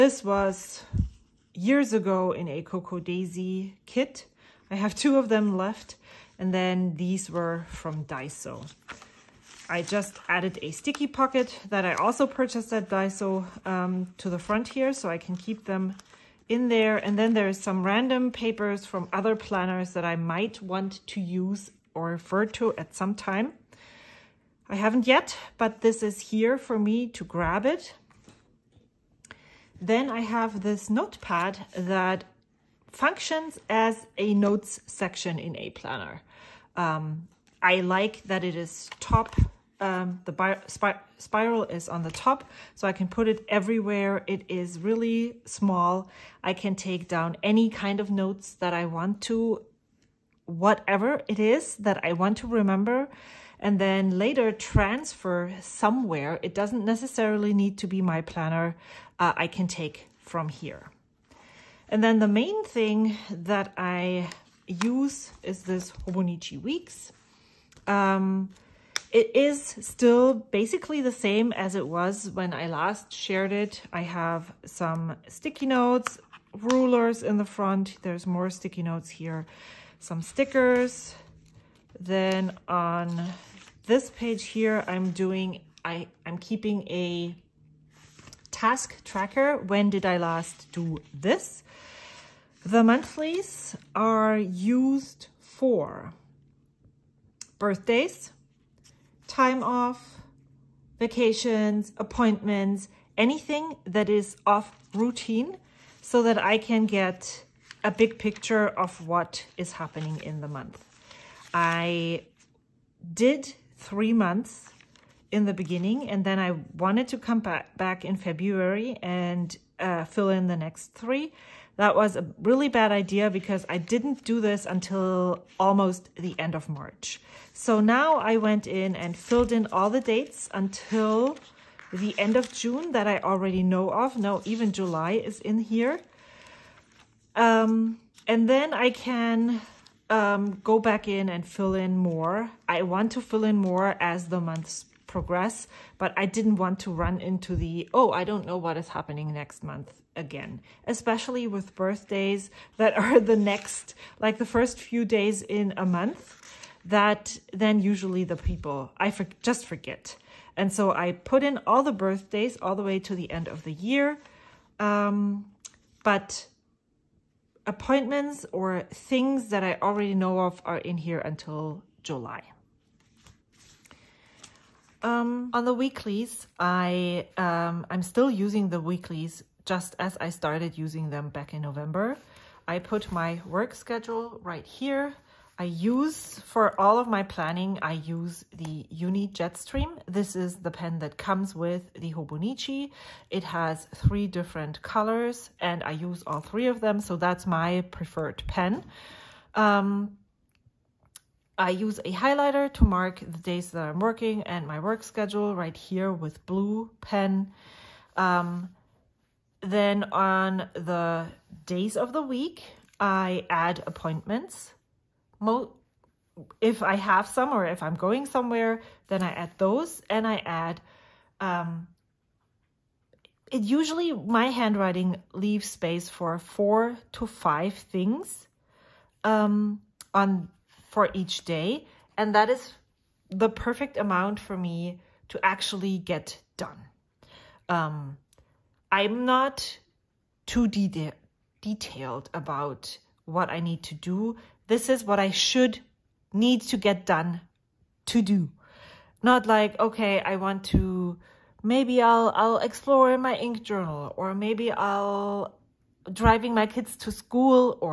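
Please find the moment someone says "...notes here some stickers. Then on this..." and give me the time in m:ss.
1:18.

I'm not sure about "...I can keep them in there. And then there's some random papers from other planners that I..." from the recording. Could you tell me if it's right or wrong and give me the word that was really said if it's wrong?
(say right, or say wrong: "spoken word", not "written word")
right.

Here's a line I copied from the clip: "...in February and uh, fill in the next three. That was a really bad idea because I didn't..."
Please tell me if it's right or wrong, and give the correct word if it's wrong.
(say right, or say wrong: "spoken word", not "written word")
right.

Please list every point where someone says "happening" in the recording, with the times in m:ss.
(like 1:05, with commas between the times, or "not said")
1:49, 2:28.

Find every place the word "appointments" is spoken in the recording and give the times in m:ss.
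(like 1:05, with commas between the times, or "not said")
1:41, 2:47, 3:33.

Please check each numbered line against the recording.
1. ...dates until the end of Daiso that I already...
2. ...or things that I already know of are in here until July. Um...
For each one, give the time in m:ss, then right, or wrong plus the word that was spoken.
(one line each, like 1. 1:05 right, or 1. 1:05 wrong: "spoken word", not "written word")
1. 2:09 wrong: "June", not "Daiso"
2. 2:48 right.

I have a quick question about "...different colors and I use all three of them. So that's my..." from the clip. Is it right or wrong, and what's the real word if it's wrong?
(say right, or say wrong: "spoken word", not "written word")
right.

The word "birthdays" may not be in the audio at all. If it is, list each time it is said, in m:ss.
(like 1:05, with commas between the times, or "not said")
1:37, 2:31, 2:41.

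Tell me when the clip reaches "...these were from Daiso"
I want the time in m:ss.
0:06.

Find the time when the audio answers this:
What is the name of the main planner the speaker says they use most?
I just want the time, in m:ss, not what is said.
1:06.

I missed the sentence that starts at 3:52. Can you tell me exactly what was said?
And that is the perfect amount for me to actually get done.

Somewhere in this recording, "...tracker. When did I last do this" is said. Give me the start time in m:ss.
1:29.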